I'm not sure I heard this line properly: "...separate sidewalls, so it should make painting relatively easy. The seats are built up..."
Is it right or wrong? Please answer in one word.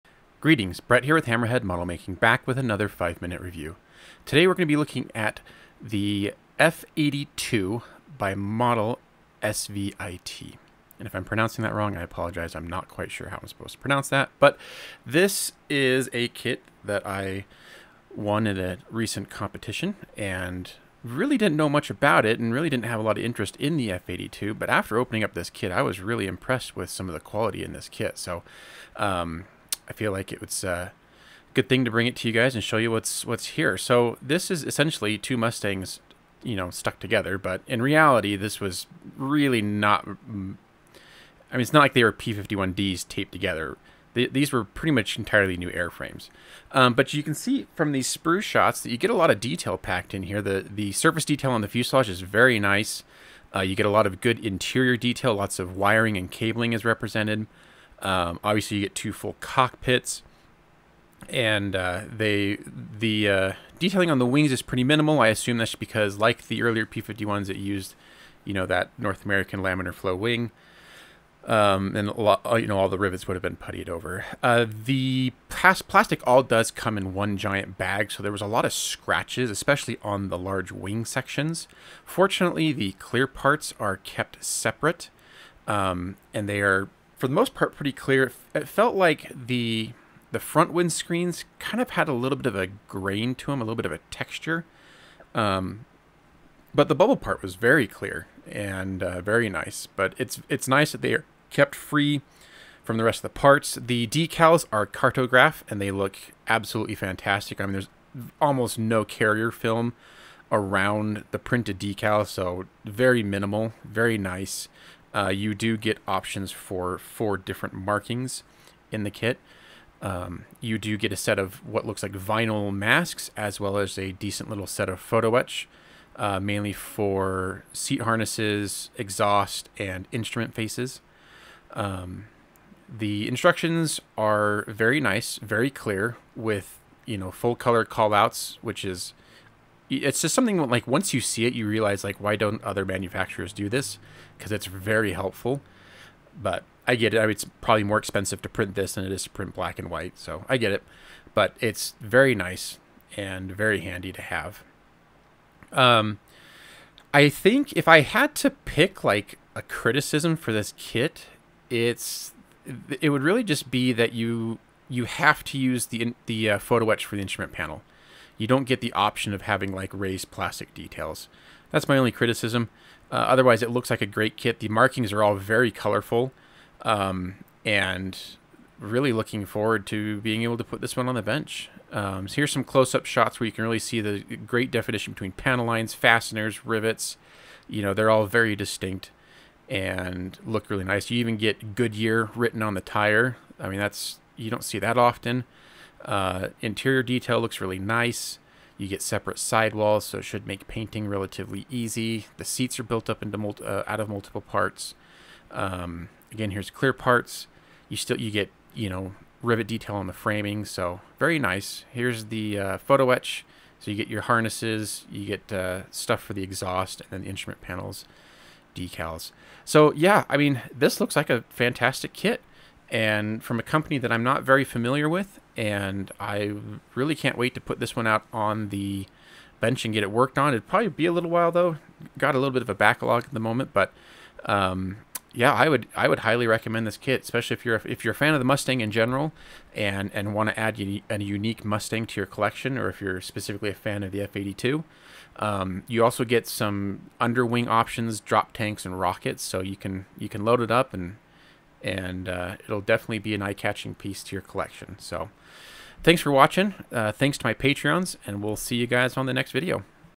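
right.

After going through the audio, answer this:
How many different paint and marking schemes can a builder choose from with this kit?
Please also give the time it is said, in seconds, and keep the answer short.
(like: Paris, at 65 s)
4, at 116 s.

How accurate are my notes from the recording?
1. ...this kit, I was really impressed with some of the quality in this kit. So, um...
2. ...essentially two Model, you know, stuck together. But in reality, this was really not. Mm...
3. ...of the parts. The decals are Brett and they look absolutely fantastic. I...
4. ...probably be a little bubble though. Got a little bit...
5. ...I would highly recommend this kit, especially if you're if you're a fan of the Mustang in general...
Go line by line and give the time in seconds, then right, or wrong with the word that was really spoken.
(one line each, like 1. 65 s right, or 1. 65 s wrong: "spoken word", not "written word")
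1. 25 s right
2. 34 s wrong: "Mustangs", not "Model"
3. 103 s wrong: "Cartograf", not "Brett"
4. 230 s wrong: "while", not "bubble"
5. 235 s right.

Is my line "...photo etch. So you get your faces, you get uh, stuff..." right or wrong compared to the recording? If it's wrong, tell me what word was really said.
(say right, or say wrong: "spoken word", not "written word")
wrong: "harnesses", not "faces".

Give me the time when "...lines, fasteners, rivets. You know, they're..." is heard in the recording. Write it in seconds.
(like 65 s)
185 s.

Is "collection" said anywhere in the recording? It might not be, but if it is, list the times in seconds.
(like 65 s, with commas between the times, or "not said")
242 s, 254 s.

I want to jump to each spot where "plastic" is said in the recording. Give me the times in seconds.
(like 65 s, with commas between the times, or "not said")
75 s, 170 s.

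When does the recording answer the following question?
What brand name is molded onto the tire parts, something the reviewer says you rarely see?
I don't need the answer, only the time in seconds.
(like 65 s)
191 s.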